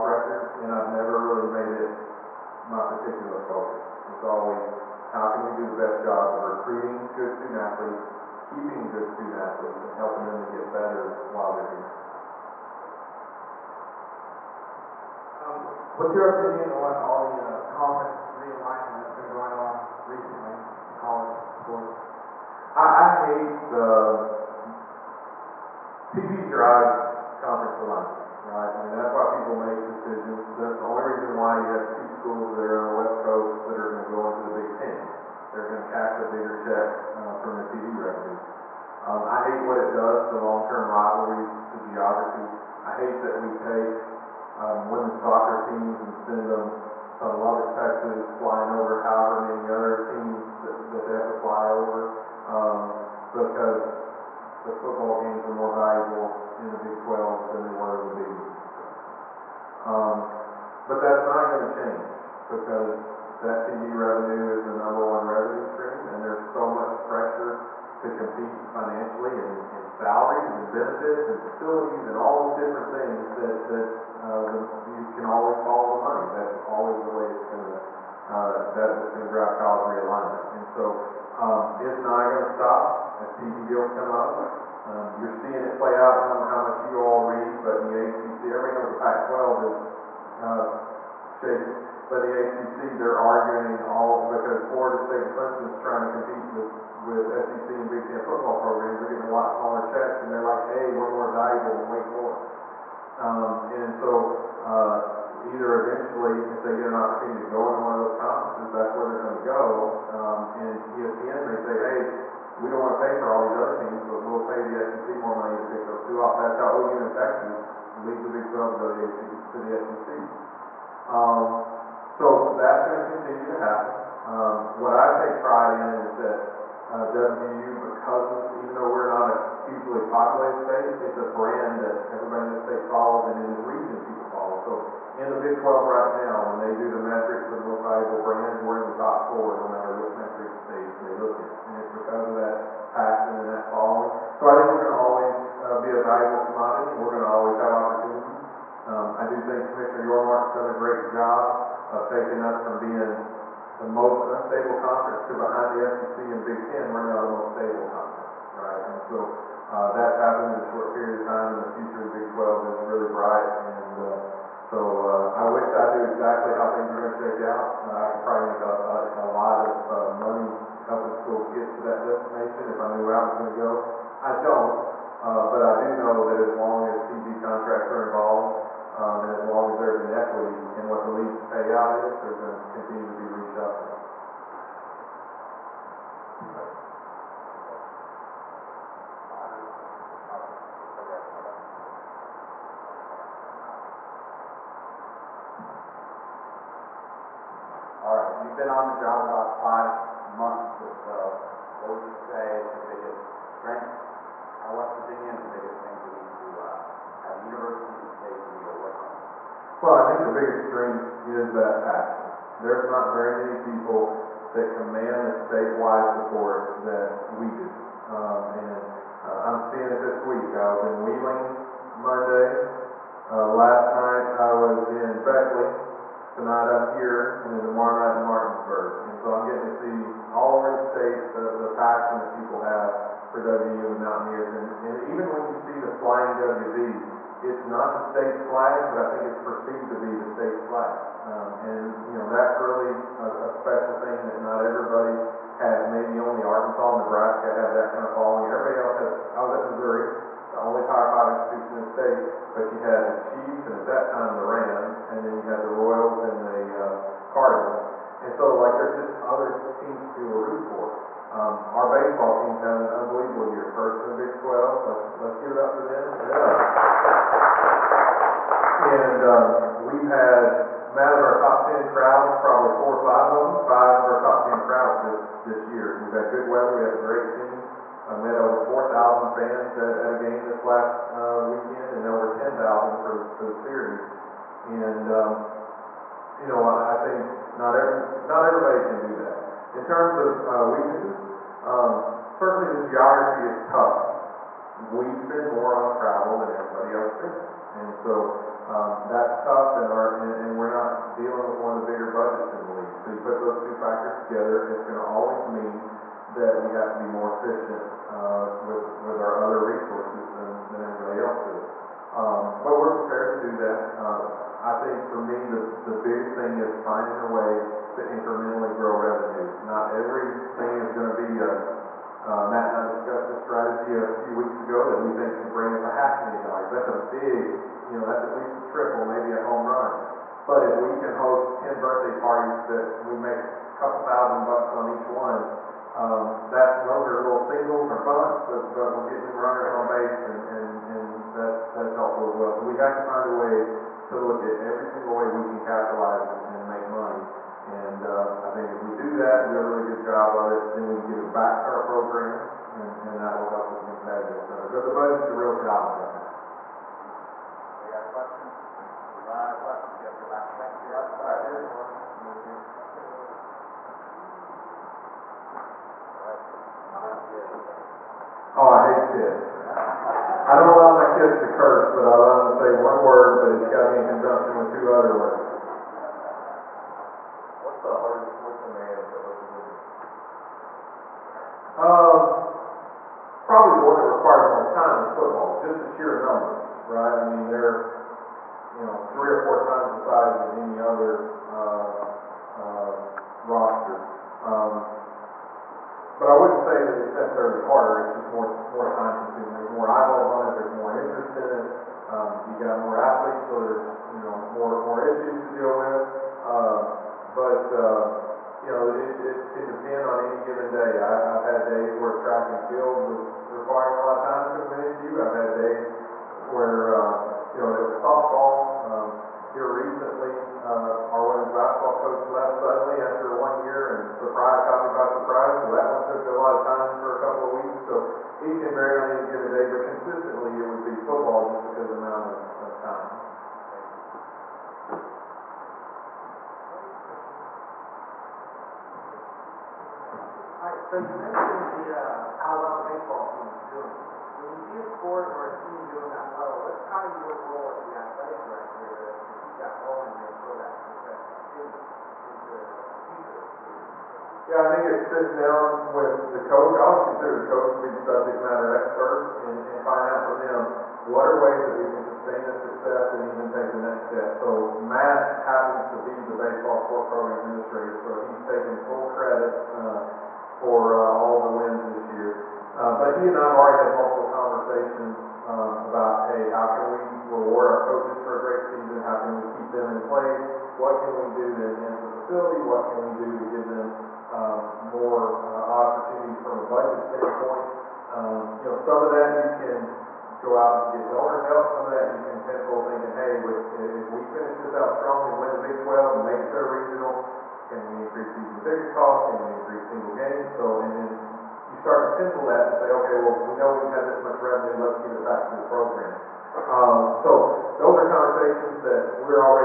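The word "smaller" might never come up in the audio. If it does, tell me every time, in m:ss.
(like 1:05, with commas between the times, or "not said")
1:39.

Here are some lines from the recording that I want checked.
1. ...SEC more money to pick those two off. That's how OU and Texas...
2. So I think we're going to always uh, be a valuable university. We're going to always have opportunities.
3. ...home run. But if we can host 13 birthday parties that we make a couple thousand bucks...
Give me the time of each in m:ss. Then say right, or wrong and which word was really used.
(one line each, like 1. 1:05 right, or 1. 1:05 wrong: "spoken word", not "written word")
1. 1:54 right
2. 2:24 wrong: "commodity", not "university"
3. 5:29 wrong: "10", not "13".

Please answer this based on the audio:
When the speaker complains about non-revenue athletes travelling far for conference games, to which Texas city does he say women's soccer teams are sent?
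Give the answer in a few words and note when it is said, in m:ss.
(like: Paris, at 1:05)
Lubbock, Texas, at 0:47.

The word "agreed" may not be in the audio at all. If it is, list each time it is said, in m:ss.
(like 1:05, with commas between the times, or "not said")
not said.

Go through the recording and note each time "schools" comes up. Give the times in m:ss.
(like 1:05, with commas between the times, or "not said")
0:32, 2:51.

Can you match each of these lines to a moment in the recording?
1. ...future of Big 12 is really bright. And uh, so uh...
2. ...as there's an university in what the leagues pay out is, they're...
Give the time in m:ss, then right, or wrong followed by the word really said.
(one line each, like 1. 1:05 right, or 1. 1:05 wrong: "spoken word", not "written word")
1. 2:41 right
2. 2:59 wrong: "equity", not "university".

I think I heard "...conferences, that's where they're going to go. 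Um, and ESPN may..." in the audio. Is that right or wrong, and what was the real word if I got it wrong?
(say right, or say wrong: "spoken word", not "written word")
right.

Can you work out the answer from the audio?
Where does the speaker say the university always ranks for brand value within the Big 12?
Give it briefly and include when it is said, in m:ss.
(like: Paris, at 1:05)
top 4, at 2:18.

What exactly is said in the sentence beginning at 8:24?
Let's give it back to the program.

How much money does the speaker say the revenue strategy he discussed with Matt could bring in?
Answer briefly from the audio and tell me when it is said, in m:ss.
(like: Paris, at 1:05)
half million dollars, at 5:25.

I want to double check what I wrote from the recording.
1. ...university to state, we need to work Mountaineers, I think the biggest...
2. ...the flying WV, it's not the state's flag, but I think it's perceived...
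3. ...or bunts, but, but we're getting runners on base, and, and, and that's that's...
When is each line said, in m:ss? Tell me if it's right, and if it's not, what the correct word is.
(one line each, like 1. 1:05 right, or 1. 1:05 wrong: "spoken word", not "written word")
1. 3:27 wrong: "Well", not "Mountaineers"
2. 3:55 right
3. 5:37 right.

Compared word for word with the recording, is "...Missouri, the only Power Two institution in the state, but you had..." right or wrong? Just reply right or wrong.
wrong.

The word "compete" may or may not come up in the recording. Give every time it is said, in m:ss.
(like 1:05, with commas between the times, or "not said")
1:08, 1:36.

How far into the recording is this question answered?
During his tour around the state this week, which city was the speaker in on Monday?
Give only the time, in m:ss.
3:41.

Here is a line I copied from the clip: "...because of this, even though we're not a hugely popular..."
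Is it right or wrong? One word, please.
right.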